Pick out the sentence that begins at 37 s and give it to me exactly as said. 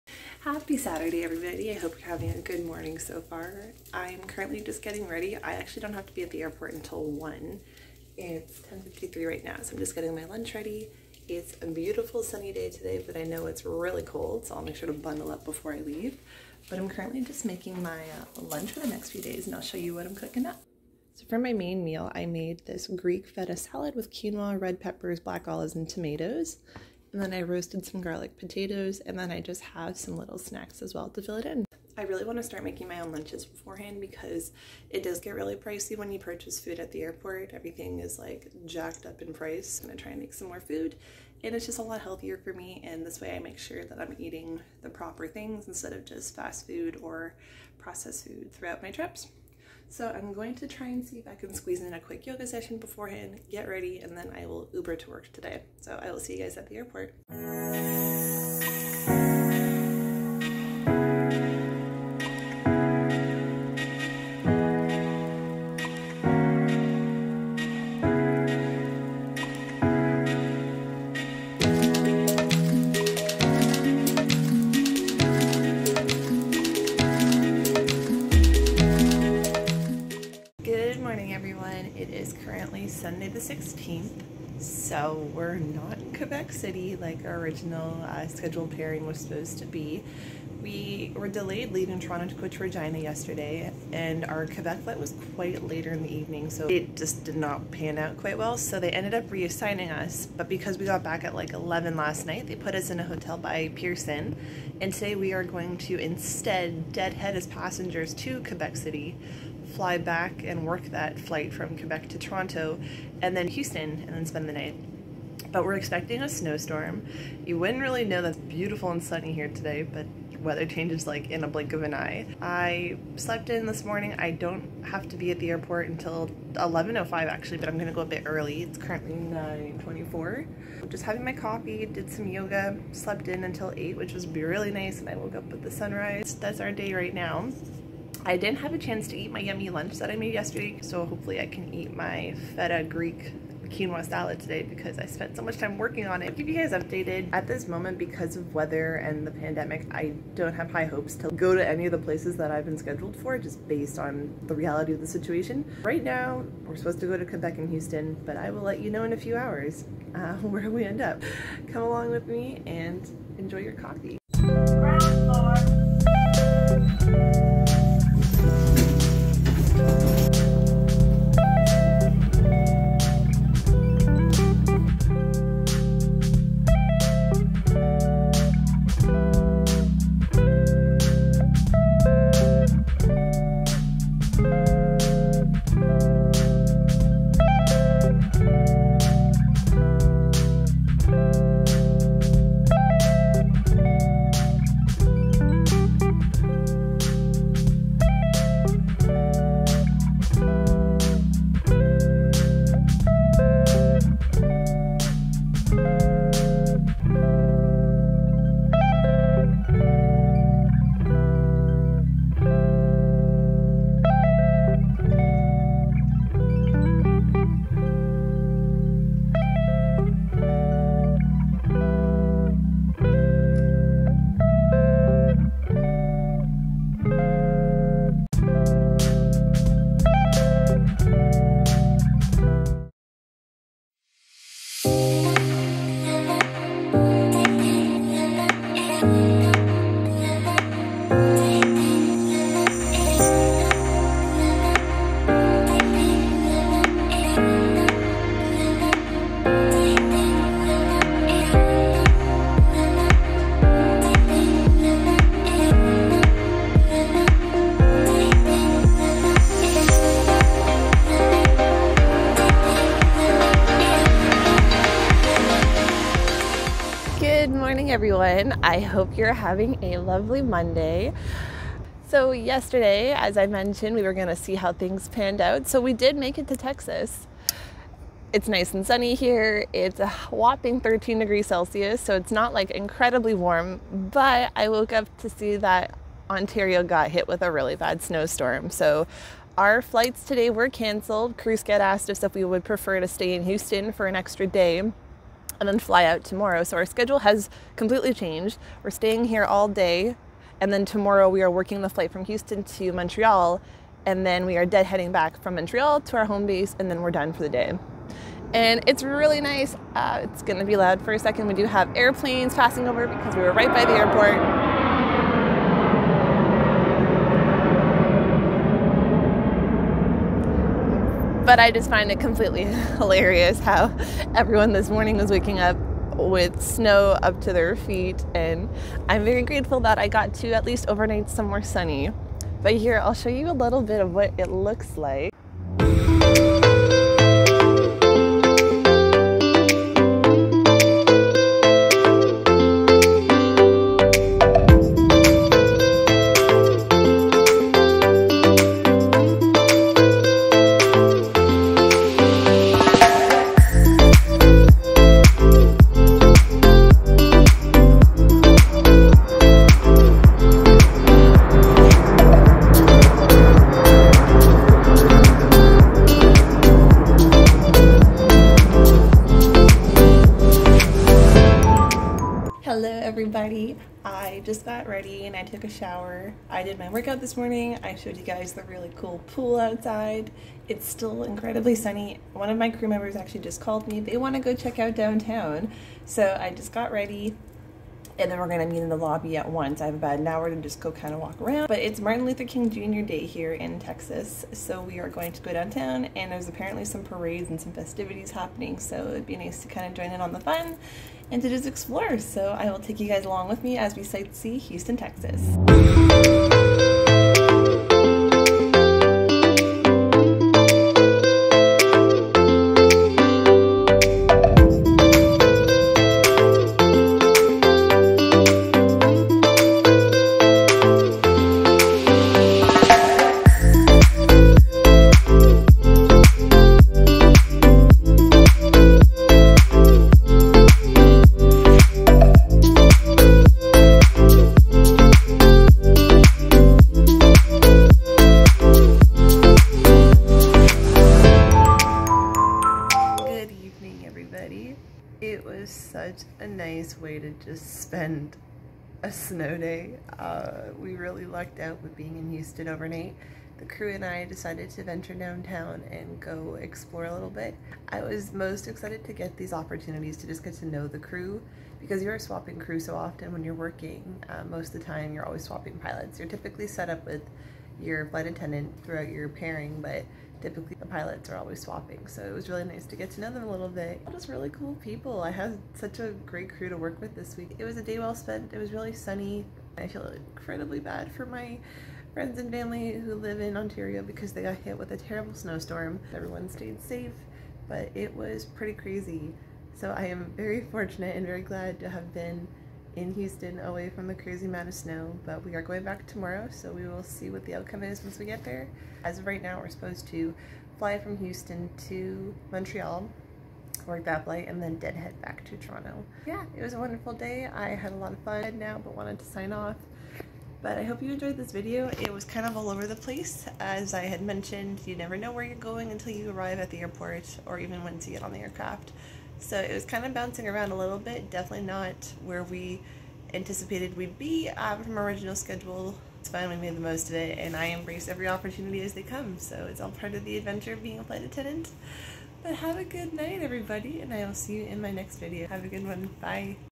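Everything is like jacked up in price.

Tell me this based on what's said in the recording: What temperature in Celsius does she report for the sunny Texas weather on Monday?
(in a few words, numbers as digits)
13 degrees.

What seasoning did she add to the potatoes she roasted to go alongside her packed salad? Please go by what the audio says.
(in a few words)
garlic.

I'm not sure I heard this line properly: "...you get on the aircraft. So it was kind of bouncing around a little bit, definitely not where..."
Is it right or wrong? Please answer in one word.
right.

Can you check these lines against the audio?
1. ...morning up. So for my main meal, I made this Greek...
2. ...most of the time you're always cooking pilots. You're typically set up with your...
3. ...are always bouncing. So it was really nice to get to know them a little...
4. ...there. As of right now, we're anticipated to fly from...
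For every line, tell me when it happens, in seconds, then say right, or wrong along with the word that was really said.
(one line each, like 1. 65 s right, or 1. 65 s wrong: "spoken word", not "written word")
1. 20 s wrong: "cooking", not "morning"
2. 464 s wrong: "swapping", not "cooking"
3. 471 s wrong: "swapping", not "bouncing"
4. 498 s wrong: "supposed", not "anticipated".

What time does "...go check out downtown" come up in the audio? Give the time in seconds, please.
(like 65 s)
384 s.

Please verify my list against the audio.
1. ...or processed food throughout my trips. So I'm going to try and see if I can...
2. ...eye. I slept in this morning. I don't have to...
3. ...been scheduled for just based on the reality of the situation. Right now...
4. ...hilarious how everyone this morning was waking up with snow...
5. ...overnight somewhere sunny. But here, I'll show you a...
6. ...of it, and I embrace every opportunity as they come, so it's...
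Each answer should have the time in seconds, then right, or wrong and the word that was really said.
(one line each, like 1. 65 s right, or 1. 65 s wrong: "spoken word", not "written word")
1. 47 s right
2. 121 s right
3. 152 s right
4. 322 s right
5. 330 s right
6. 527 s right.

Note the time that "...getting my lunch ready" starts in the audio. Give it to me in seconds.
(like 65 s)
9 s.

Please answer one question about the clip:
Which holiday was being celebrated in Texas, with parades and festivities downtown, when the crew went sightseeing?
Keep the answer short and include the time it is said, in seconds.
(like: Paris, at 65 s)
Martin Luther King Jr. Day, at 391 s.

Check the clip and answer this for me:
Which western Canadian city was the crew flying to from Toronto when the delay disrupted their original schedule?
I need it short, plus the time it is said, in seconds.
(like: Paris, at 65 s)
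Regina, at 92 s.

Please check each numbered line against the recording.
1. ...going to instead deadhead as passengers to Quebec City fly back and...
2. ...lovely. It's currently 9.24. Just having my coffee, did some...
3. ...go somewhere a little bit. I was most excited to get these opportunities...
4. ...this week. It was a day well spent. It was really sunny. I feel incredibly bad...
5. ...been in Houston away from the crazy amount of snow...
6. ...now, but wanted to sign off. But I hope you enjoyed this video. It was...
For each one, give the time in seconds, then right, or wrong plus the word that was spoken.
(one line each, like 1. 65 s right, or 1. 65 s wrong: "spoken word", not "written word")
1. 105 s right
2. 128 s wrong: "early", not "lovely"
3. 456 s wrong: "explore", not "somewhere"
4. 477 s right
5. 492 s right
6. 508 s right.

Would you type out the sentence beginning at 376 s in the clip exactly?
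I did my workout this morning.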